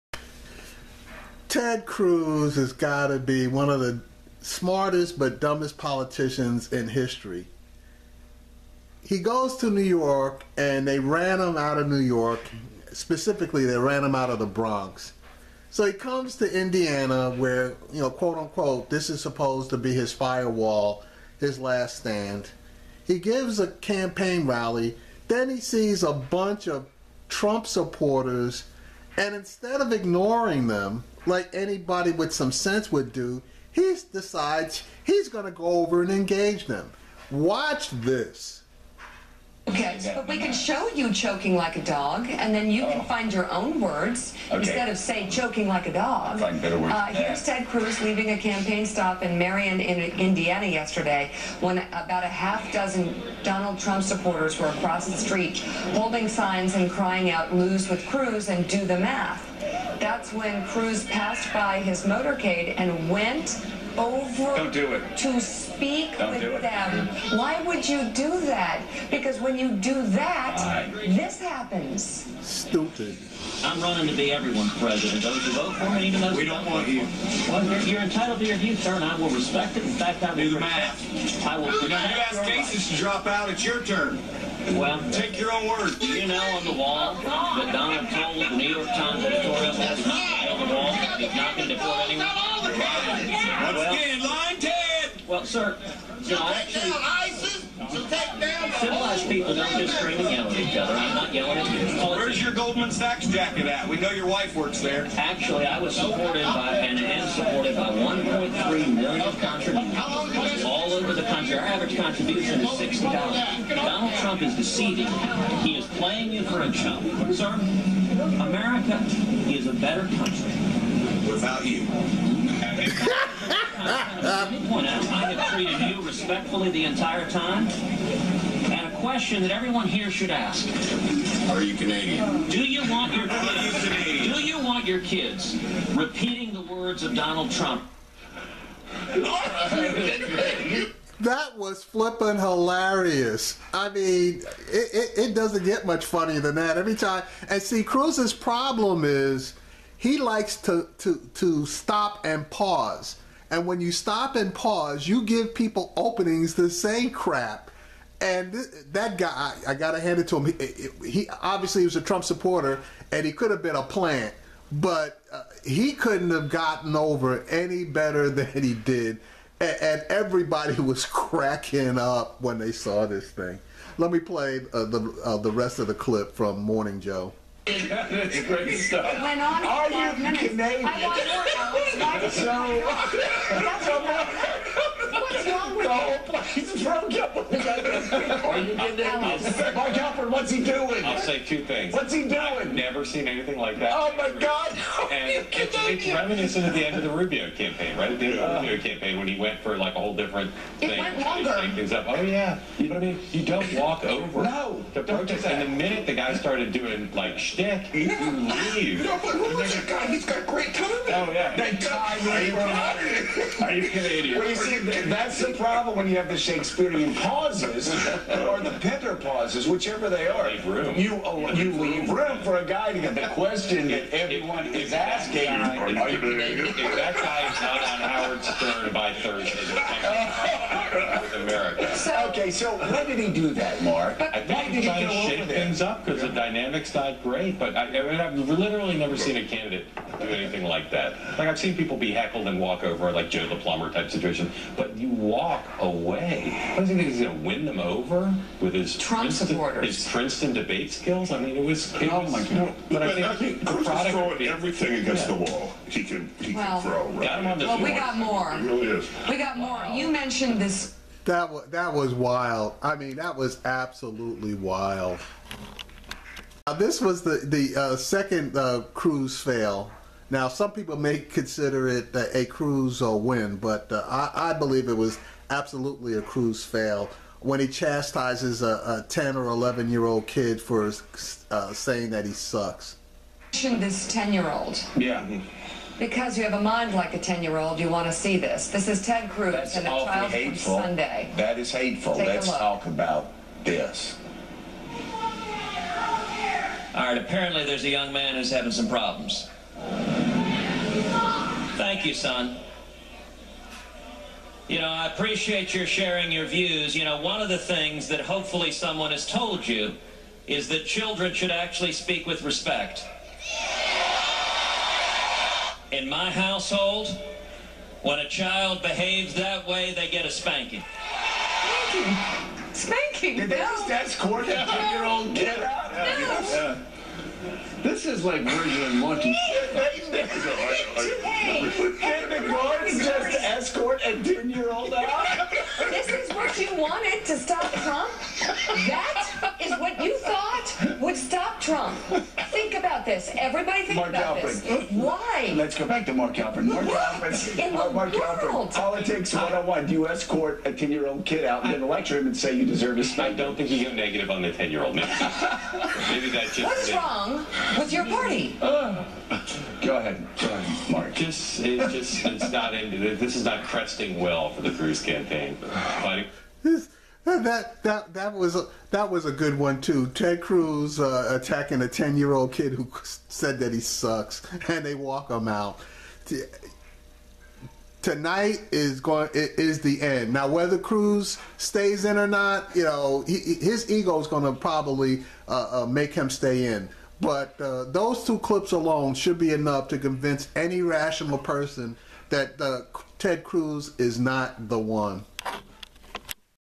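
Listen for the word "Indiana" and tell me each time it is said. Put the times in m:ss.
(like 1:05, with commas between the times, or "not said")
0:16, 0:50.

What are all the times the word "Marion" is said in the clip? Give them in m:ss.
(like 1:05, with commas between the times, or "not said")
0:49.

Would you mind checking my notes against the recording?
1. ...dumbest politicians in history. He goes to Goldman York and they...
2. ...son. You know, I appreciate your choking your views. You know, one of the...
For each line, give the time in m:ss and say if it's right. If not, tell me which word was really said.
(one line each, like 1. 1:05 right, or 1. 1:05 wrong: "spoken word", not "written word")
1. 0:05 wrong: "New", not "Goldman"
2. 5:02 wrong: "sharing", not "choking".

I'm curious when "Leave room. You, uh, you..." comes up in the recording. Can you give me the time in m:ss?
3:40.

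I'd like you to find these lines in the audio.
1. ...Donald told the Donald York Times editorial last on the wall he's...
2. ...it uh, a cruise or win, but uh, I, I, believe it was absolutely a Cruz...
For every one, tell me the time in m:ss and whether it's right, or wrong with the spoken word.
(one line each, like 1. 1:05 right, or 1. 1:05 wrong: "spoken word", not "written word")
1. 1:27 wrong: "New", not "Donald"
2. 4:31 right.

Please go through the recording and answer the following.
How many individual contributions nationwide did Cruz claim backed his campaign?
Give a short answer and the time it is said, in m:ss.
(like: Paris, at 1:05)
1.3 million, at 1:47.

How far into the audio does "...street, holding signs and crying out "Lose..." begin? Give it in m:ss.
0:55.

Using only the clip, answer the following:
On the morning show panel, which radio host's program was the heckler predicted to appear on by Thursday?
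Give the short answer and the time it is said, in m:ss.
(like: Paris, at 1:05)
Howard Stern, at 3:48.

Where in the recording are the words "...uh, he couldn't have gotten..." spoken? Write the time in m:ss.
2:45.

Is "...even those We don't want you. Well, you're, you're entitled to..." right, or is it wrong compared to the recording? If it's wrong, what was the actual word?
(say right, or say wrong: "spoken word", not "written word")
right.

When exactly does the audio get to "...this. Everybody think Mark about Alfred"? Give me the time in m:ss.
5:43.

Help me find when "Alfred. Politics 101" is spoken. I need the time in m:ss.
5:48.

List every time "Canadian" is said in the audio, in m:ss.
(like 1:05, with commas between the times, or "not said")
2:11, 3:00, 3:08, 3:33, 3:46.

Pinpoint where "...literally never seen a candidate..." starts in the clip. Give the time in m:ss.
3:58.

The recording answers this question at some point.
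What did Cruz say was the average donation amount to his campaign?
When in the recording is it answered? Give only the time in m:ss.
1:52.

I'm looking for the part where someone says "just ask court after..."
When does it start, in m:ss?
5:23.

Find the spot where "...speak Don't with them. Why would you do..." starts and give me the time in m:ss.
1:05.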